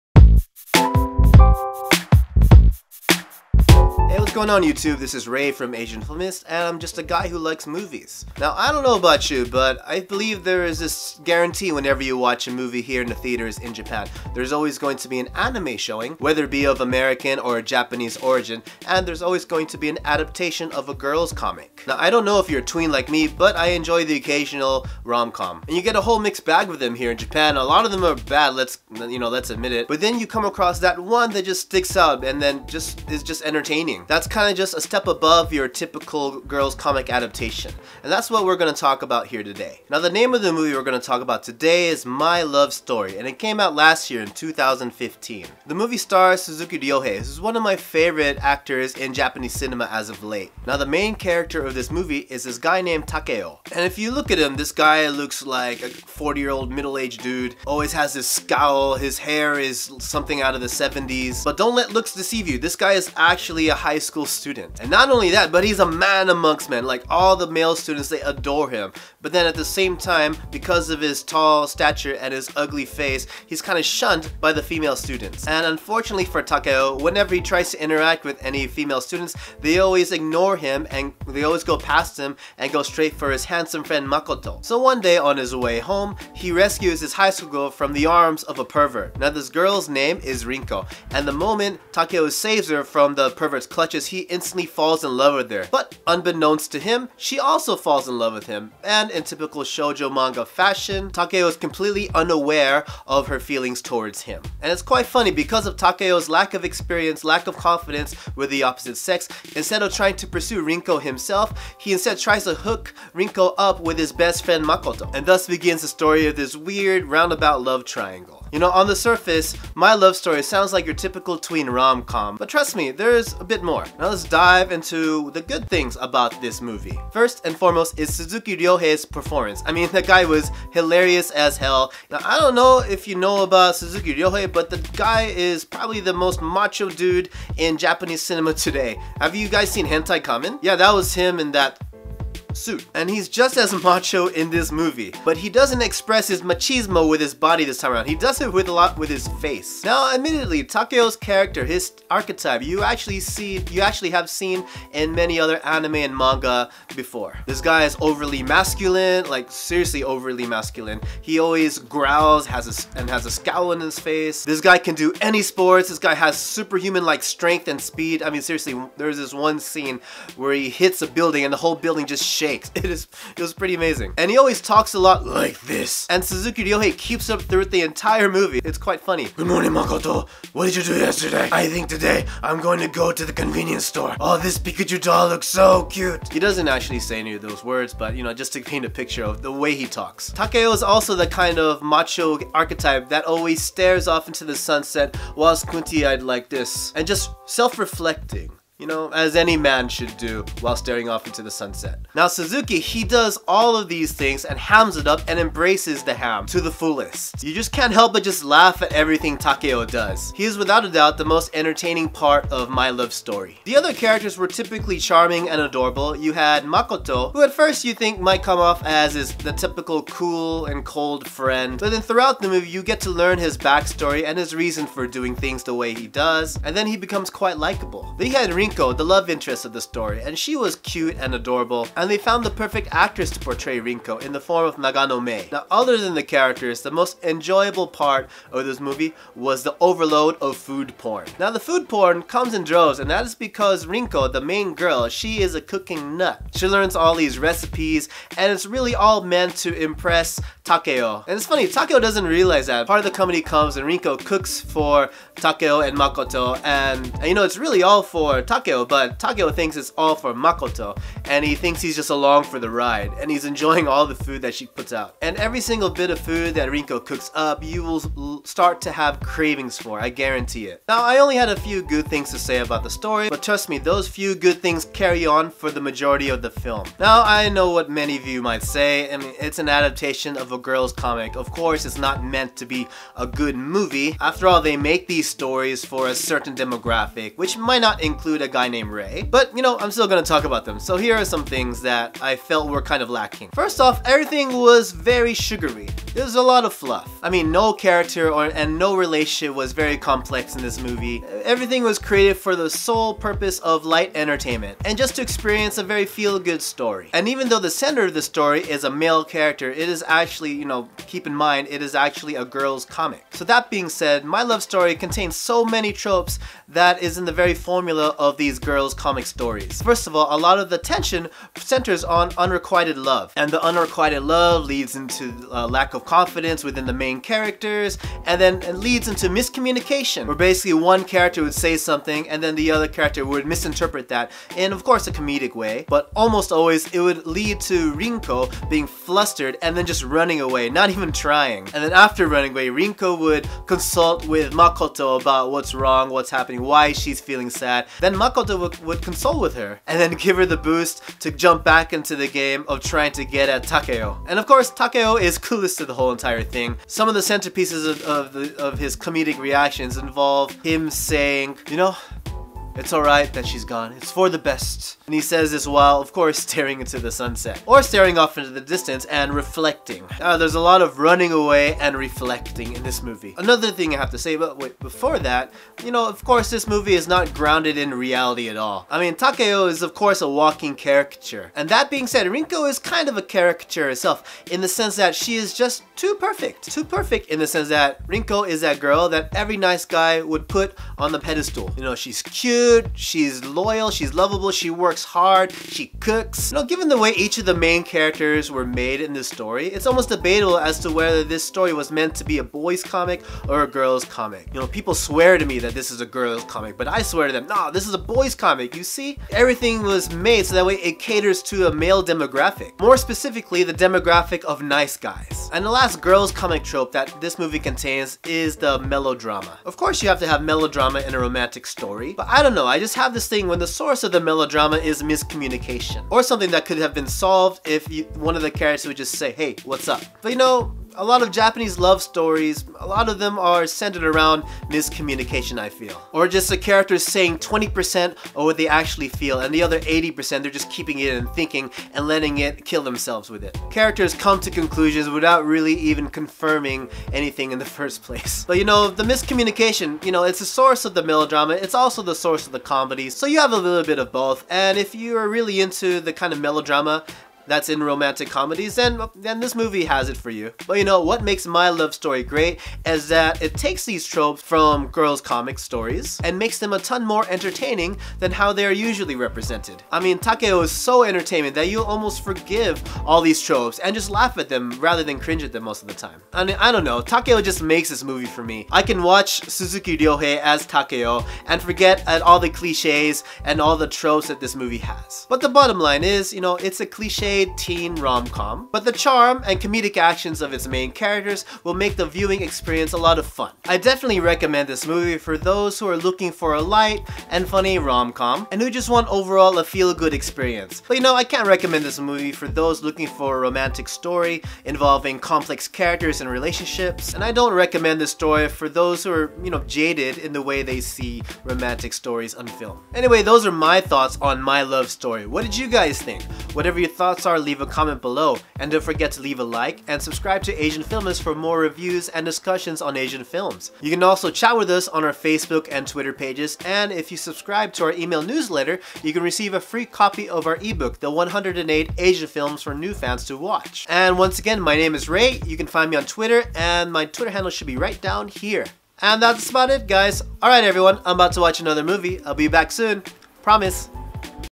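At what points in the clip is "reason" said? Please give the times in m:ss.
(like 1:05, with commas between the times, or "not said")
3:44.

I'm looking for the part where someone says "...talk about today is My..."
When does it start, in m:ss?
0:41.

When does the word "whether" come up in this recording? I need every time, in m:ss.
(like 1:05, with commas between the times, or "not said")
0:16, 6:40.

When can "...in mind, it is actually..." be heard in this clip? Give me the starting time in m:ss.
5:11.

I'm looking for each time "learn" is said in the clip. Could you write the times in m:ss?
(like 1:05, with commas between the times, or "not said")
3:43, 4:06.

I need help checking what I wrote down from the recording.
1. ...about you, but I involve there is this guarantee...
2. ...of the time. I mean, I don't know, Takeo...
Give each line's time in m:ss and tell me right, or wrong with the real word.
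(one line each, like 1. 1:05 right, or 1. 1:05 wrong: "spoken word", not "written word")
1. 0:08 wrong: "believe", not "involve"
2. 7:55 right.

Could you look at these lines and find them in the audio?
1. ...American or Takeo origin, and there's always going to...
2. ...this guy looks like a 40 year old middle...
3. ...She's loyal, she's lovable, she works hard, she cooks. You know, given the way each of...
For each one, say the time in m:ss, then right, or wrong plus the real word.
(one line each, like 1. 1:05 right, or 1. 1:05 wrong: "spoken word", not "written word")
1. 0:16 wrong: "Japanese", not "Takeo"
2. 0:54 right
3. 6:32 right.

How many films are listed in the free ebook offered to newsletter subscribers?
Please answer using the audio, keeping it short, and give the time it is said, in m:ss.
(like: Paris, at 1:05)
108, at 8:51.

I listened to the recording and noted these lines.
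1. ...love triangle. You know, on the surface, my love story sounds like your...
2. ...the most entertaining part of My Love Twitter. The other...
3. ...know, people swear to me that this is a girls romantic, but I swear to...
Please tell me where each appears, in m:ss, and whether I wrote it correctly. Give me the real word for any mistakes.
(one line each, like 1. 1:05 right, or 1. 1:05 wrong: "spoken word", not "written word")
1. 1:57 right
2. 3:31 wrong: "Story", not "Twitter"
3. 6:44 wrong: "comic", not "romantic".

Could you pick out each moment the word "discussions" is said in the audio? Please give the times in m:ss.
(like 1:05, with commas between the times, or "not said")
8:42.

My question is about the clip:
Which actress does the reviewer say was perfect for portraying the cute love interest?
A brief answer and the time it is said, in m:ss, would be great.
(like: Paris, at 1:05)
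Nagano Mei, at 3:54.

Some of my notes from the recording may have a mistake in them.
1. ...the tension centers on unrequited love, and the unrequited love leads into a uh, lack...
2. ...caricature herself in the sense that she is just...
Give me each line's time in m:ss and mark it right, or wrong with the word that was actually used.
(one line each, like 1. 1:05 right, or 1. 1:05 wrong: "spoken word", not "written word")
1. 5:20 right
2. 6:23 right.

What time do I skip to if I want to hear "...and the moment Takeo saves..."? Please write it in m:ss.
1:31.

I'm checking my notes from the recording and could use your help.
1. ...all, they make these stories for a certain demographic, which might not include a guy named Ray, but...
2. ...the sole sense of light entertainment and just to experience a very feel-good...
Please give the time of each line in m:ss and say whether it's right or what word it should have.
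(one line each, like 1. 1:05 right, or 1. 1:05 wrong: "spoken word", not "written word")
1. 4:44 right
2. 5:02 wrong: "purpose", not "sense".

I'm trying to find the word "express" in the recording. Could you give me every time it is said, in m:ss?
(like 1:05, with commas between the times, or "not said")
2:25.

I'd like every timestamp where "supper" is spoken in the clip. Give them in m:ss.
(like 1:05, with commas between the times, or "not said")
not said.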